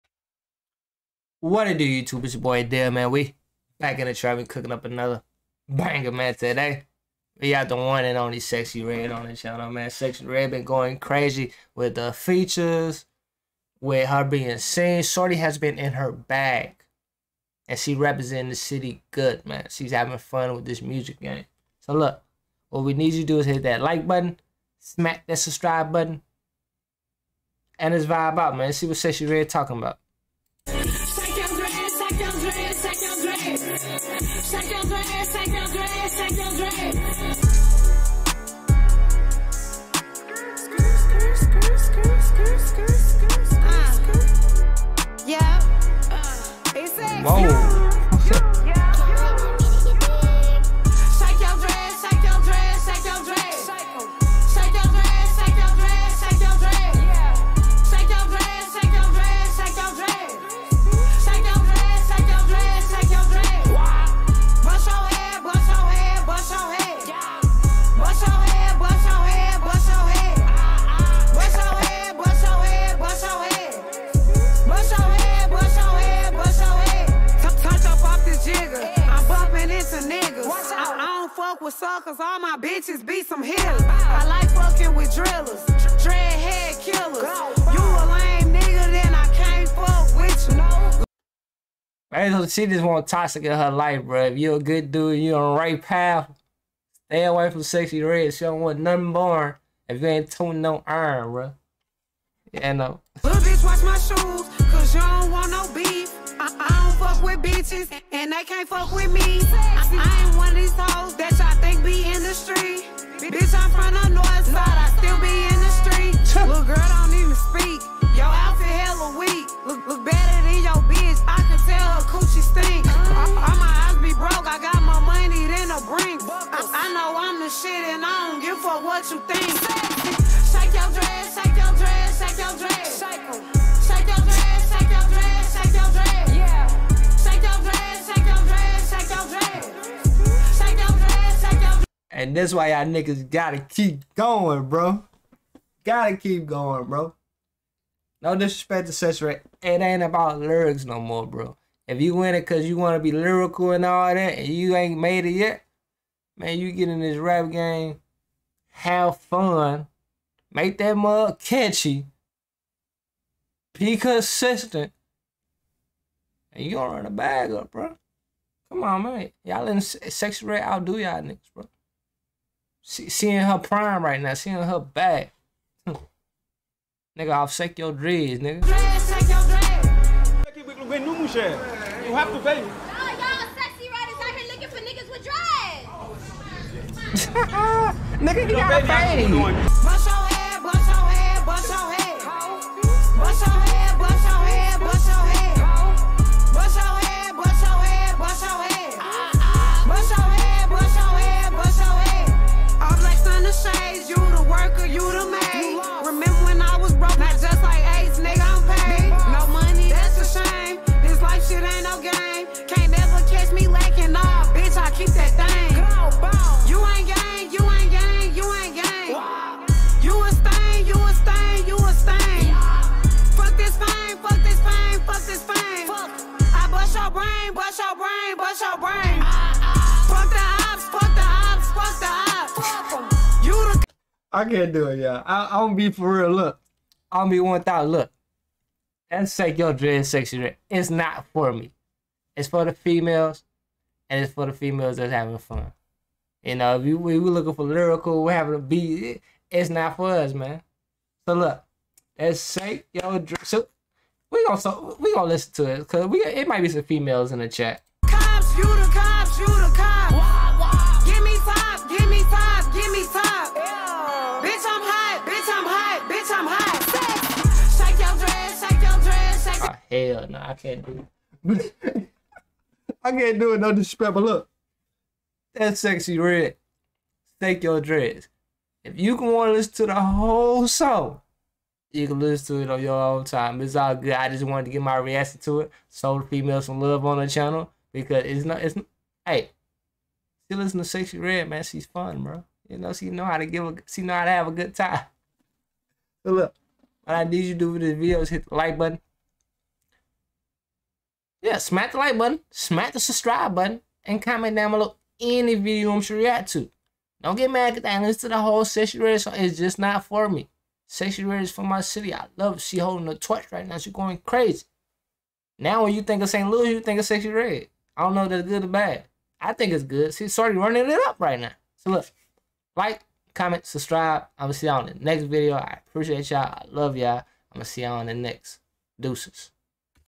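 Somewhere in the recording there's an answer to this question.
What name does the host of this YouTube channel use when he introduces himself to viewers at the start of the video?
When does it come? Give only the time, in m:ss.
0:02.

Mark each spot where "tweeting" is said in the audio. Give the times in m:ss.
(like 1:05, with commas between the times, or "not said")
not said.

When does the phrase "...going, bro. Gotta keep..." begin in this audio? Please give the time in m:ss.
2:24.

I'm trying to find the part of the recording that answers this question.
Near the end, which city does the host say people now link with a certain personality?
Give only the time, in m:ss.
5:16.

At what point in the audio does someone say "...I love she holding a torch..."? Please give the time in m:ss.
5:12.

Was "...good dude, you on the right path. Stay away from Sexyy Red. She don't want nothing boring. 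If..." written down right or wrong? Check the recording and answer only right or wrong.
right.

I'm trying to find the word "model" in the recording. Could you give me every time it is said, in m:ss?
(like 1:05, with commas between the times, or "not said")
not said.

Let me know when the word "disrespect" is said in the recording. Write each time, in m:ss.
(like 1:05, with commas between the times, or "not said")
2:28, 4:33.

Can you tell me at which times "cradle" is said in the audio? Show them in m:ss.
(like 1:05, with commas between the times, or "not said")
not said.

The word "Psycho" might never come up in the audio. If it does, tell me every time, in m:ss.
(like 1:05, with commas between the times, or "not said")
4:12.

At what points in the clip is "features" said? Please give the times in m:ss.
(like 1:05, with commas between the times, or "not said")
0:12.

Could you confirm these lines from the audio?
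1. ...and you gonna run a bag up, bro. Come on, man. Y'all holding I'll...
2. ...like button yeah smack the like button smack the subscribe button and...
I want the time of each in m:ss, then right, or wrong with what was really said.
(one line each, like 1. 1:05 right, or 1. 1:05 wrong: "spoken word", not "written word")
1. 2:46 wrong: "letting", not "holding"
2. 4:58 right.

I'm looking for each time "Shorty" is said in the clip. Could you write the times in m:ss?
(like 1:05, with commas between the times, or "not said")
0:15.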